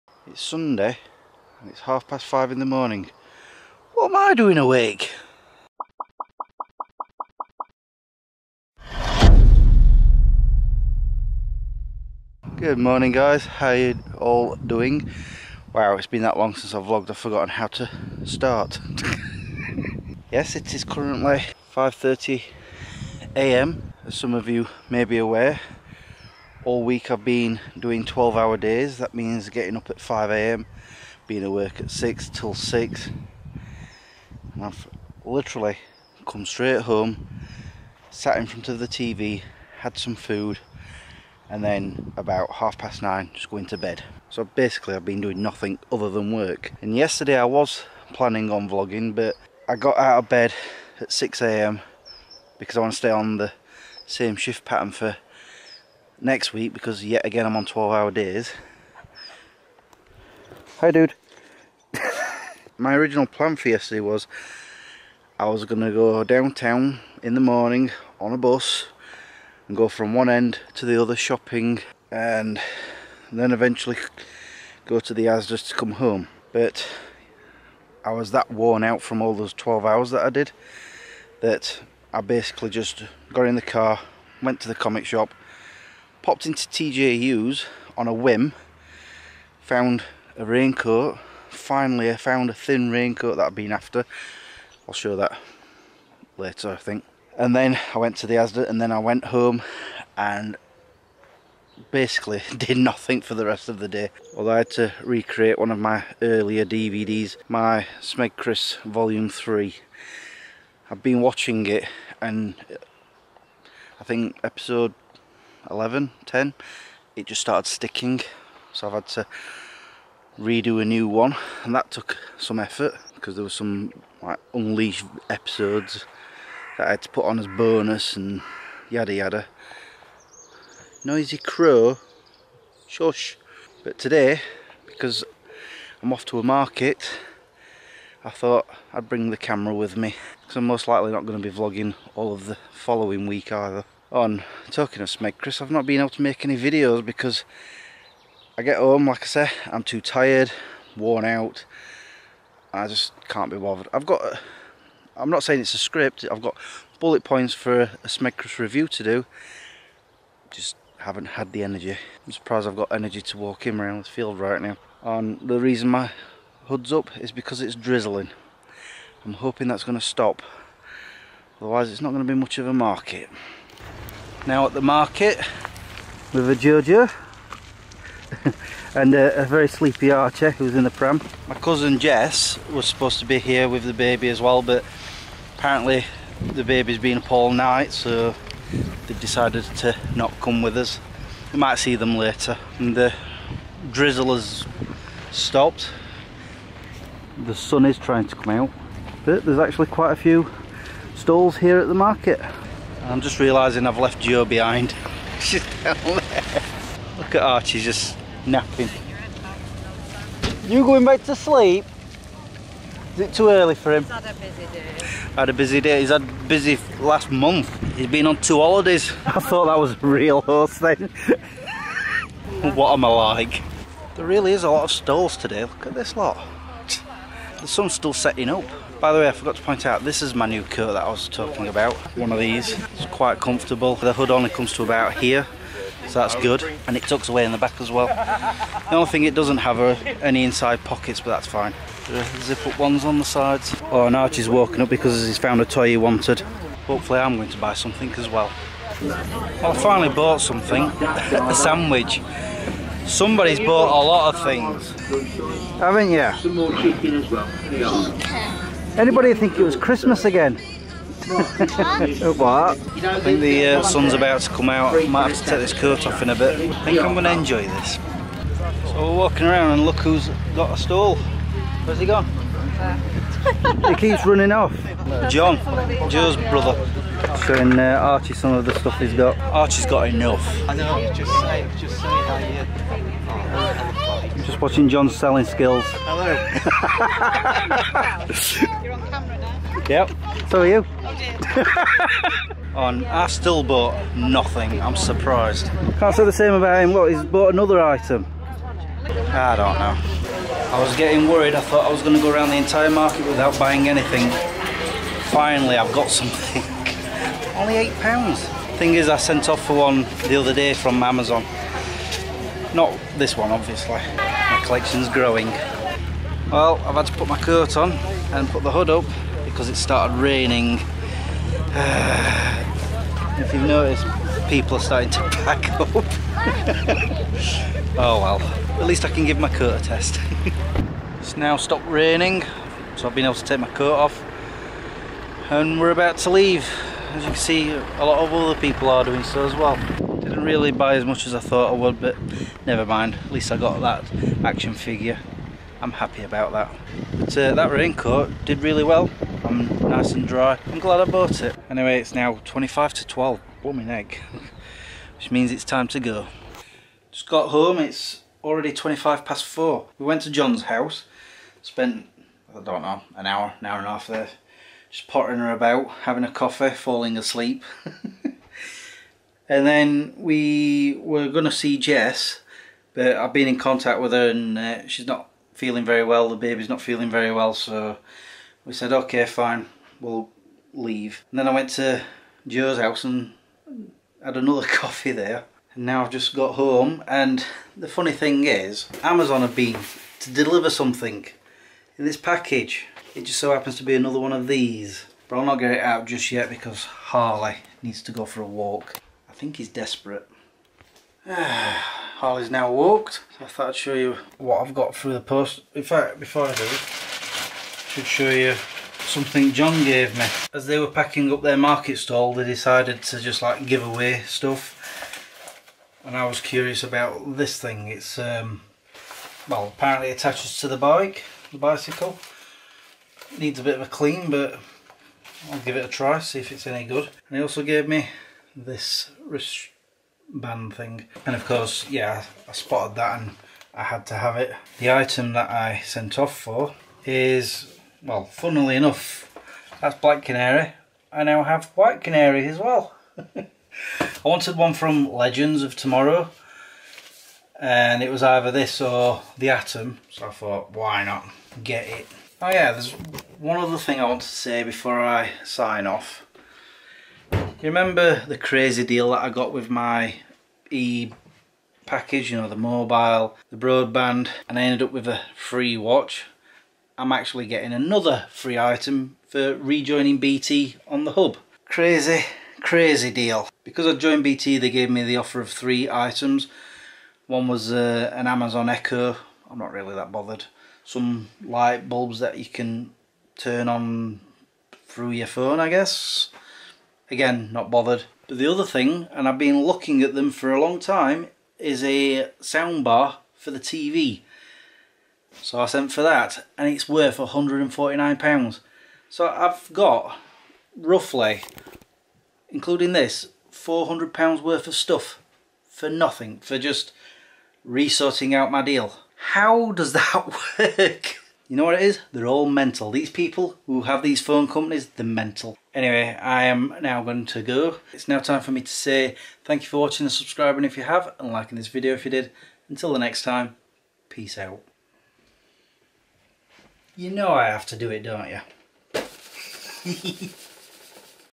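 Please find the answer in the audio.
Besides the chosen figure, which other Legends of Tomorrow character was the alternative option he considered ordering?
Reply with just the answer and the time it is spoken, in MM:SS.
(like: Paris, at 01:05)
the Atom, at 07:29.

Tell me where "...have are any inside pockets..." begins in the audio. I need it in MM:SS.
03:59.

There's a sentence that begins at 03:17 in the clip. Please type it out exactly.
The sun is trying to come out but there's actually quite a few stalls here at the market.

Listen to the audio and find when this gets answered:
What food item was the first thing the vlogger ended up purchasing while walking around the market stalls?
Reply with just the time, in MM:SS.
04:10.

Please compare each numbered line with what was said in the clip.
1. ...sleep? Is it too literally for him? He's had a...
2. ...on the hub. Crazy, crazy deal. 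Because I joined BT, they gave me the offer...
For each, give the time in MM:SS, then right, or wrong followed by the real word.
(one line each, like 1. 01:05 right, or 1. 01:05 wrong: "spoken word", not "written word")
1. 03:31 wrong: "early", not "literally"
2. 07:50 right.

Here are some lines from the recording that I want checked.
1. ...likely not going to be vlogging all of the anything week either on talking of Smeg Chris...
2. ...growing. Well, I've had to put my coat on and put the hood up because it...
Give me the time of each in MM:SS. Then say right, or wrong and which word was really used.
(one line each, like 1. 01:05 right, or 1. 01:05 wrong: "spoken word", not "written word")
1. 02:20 wrong: "following", not "anything"
2. 05:15 right.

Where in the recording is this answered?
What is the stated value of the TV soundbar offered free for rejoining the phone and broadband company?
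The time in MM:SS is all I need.
08:17.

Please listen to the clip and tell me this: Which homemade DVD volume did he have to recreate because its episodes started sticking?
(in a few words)
Smeg Chris Volume 3.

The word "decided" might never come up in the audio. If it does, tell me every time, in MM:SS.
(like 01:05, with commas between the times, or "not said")
03:09, 06:52.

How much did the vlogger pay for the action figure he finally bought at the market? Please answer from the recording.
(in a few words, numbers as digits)
8 pounds.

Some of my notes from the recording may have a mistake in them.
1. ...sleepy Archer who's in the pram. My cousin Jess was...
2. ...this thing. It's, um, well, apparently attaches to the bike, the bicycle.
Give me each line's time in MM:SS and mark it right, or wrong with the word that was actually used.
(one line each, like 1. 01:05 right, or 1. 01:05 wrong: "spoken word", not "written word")
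1. 02:59 right
2. 06:57 right.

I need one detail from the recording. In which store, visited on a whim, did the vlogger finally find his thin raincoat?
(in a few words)
TJ Hughes.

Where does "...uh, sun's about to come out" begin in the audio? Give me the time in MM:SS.
04:23.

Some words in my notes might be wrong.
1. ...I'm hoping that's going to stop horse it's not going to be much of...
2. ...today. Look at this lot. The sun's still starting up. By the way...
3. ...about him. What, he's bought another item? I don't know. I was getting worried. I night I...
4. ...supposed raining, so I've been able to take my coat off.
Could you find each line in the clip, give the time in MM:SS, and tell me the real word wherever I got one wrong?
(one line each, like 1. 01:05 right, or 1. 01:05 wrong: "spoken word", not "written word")
1. 02:49 wrong: "otherwise", not "horse"
2. 03:45 wrong: "setting", not "starting"
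3. 04:56 wrong: "thought", not "night"
4. 05:31 wrong: "stopped", not "supposed".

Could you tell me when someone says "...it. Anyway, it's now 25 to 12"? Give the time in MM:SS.
05:51.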